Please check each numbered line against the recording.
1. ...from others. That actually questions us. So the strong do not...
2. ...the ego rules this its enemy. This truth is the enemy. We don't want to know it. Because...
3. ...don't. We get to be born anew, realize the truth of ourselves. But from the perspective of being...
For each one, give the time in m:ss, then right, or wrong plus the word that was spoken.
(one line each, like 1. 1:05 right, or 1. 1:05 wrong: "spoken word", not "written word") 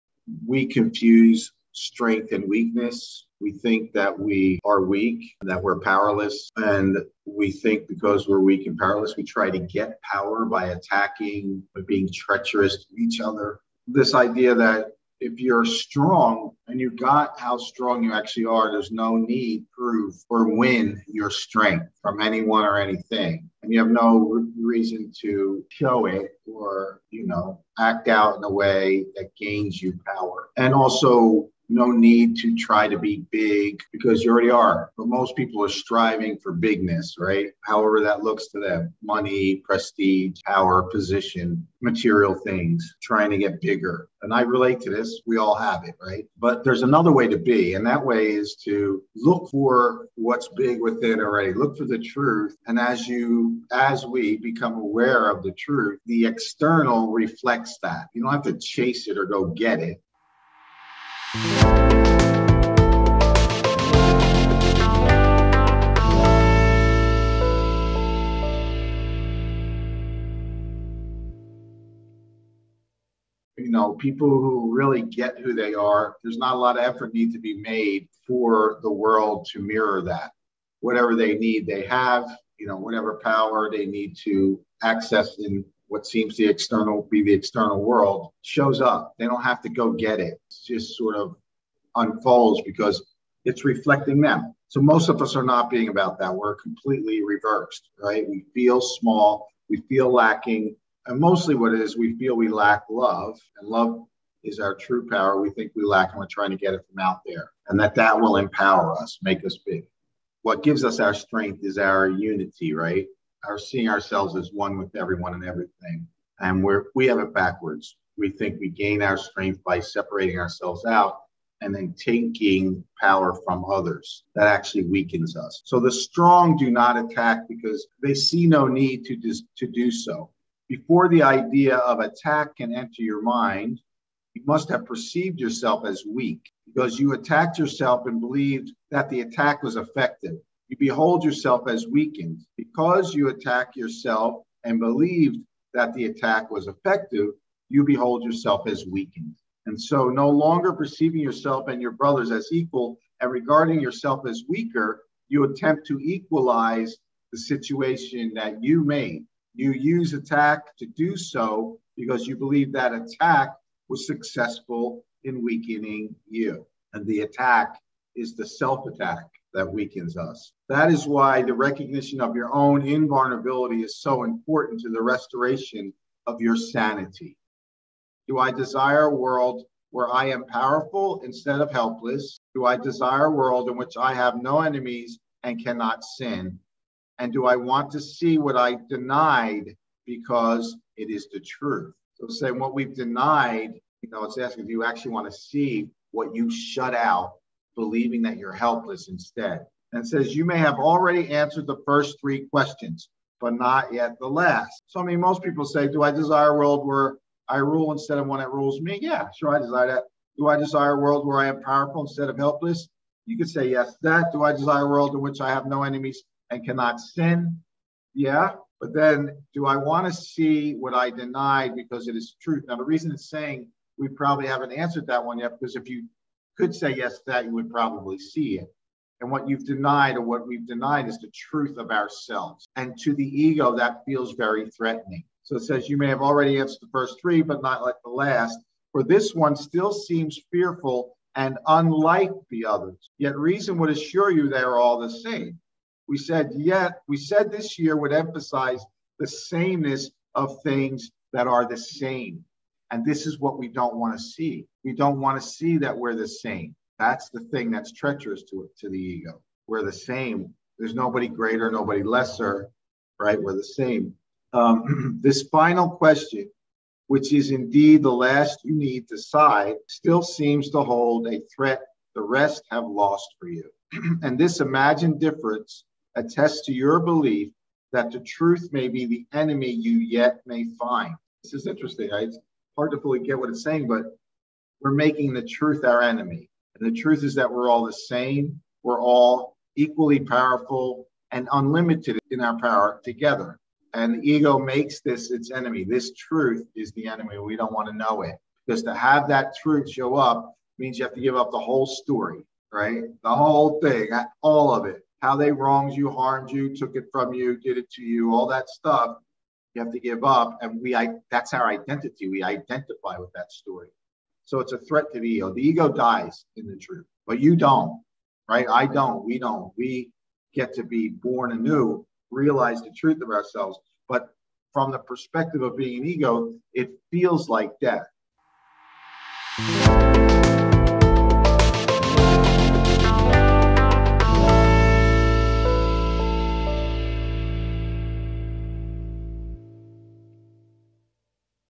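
1. 2:03 wrong: "weakens", not "questions"
2. 4:54 wrong: "makes", not "rules"
3. 5:19 right.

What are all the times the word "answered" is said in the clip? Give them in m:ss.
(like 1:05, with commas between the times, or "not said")
3:21, 3:44, 3:56.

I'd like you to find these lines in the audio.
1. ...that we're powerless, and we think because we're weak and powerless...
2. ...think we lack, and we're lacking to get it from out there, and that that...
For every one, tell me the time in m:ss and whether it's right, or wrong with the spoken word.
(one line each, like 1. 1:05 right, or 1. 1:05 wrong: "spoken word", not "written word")
1. 0:05 right
2. 1:45 wrong: "trying", not "lacking".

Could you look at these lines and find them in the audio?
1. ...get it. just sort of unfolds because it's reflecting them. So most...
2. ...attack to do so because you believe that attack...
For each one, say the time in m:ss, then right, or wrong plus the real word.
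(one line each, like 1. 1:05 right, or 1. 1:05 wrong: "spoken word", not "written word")
1. 1:29 right
2. 2:40 right.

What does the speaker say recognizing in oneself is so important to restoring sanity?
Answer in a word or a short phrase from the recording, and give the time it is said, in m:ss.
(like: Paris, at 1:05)
invulnerability, at 2:52.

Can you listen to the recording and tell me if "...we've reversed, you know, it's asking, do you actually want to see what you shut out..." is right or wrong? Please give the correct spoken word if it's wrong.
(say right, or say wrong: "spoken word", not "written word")
wrong: "denied", not "reversed".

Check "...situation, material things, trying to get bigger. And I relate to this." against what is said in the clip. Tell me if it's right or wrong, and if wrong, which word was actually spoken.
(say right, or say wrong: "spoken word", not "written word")
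wrong: "position", not "situation".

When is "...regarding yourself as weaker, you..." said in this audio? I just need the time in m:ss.
2:33.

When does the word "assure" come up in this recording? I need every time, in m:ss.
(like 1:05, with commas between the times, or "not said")
4:03.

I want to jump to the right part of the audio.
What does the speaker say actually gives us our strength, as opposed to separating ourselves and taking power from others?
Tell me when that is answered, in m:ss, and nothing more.
1:51.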